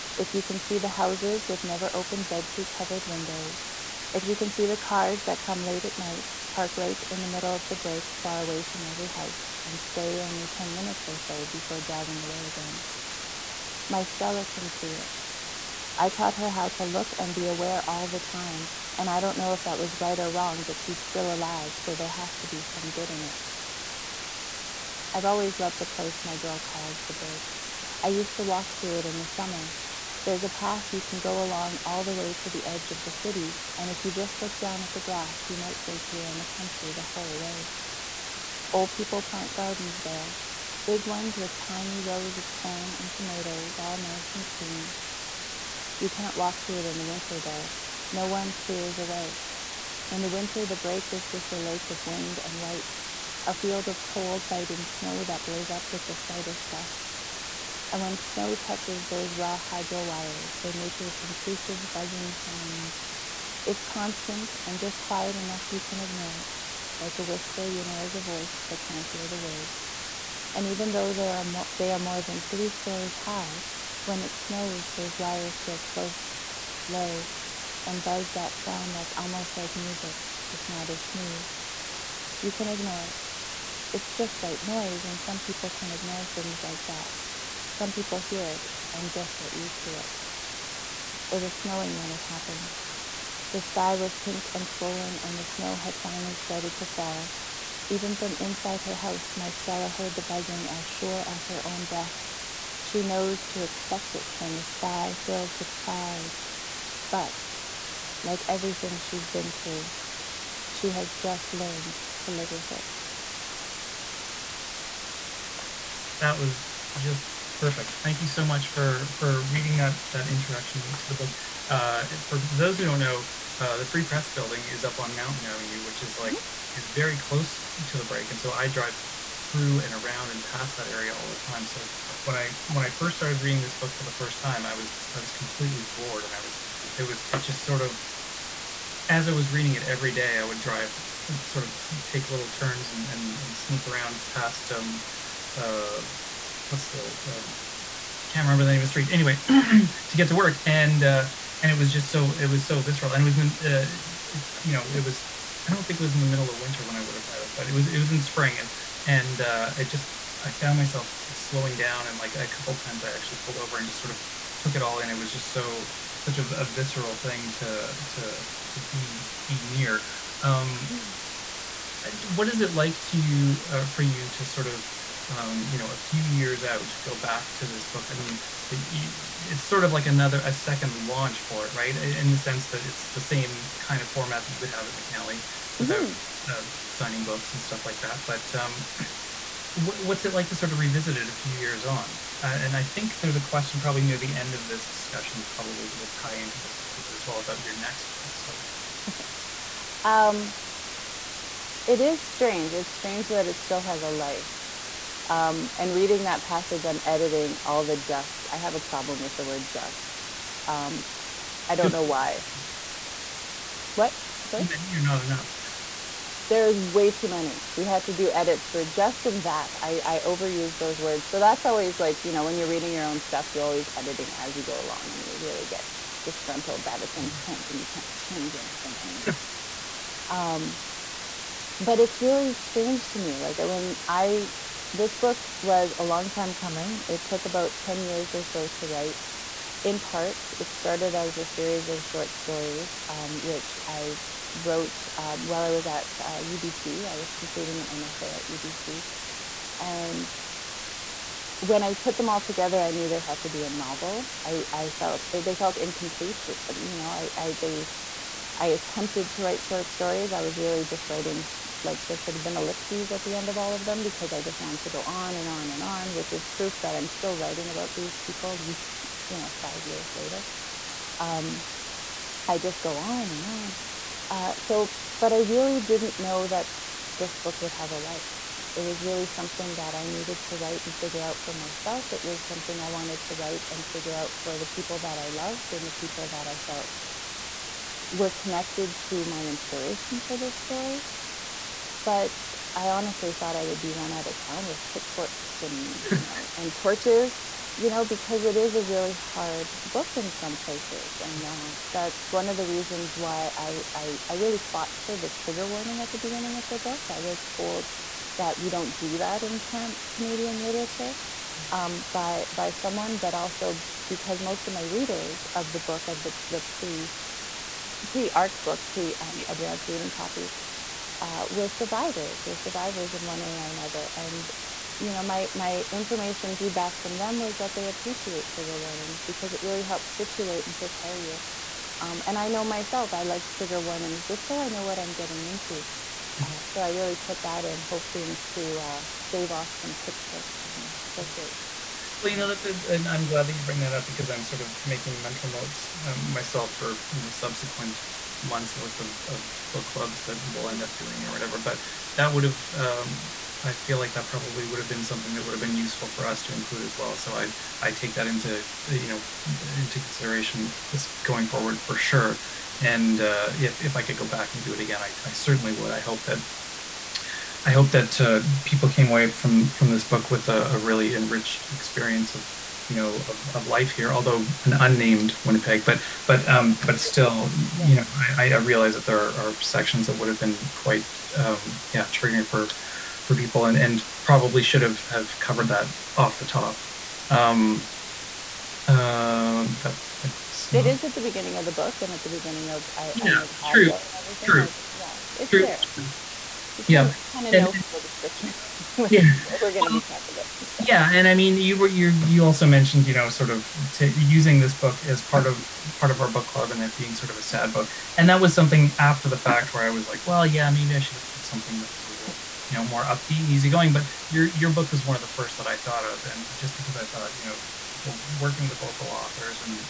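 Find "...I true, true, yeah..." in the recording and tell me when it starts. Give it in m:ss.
6:33.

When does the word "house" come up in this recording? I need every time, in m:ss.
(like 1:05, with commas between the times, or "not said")
0:00, 0:09, 1:38.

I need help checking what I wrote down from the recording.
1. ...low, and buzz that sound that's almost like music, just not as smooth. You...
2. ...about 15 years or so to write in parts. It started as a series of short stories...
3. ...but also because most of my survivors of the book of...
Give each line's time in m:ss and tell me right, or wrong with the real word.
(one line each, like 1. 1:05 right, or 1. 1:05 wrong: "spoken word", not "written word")
1. 1:16 right
2. 3:57 wrong: "10", not "15"
3. 5:13 wrong: "readers", not "survivors".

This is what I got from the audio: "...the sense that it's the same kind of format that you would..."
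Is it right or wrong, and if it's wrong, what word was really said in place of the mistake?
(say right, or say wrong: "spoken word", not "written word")
right.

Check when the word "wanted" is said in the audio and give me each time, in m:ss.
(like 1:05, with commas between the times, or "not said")
4:24, 4:42.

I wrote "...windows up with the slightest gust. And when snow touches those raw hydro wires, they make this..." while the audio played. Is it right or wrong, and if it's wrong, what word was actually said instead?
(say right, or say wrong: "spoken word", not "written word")
wrong: "blows", not "windows".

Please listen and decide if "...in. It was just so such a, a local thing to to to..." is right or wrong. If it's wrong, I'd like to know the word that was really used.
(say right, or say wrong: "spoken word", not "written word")
wrong: "visceral", not "local".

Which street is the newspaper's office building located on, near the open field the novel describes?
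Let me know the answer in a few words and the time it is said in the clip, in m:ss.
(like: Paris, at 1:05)
Mountain Avenue, at 2:05.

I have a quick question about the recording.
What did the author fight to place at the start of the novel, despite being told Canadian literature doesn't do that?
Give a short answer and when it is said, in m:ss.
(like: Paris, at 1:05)
trigger warning, at 5:05.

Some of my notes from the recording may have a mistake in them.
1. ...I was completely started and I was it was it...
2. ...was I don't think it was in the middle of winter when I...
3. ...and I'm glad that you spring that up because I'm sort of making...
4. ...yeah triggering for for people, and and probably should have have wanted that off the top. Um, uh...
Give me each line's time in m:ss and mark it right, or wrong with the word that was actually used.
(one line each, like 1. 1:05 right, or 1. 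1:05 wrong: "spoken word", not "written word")
1. 2:15 wrong: "floored", not "started"
2. 2:35 right
3. 5:42 wrong: "bring", not "spring"
4. 6:21 wrong: "covered", not "wanted".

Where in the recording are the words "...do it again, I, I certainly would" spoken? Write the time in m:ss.
6:04.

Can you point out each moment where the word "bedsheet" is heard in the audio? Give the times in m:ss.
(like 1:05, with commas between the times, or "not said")
0:02.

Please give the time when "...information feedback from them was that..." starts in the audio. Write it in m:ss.
5:25.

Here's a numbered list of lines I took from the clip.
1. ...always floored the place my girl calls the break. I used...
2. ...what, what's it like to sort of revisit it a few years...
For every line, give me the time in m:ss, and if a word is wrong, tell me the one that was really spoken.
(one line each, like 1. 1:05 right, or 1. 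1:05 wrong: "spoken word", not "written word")
1. 0:25 wrong: "loved", not "floored"
2. 3:09 right.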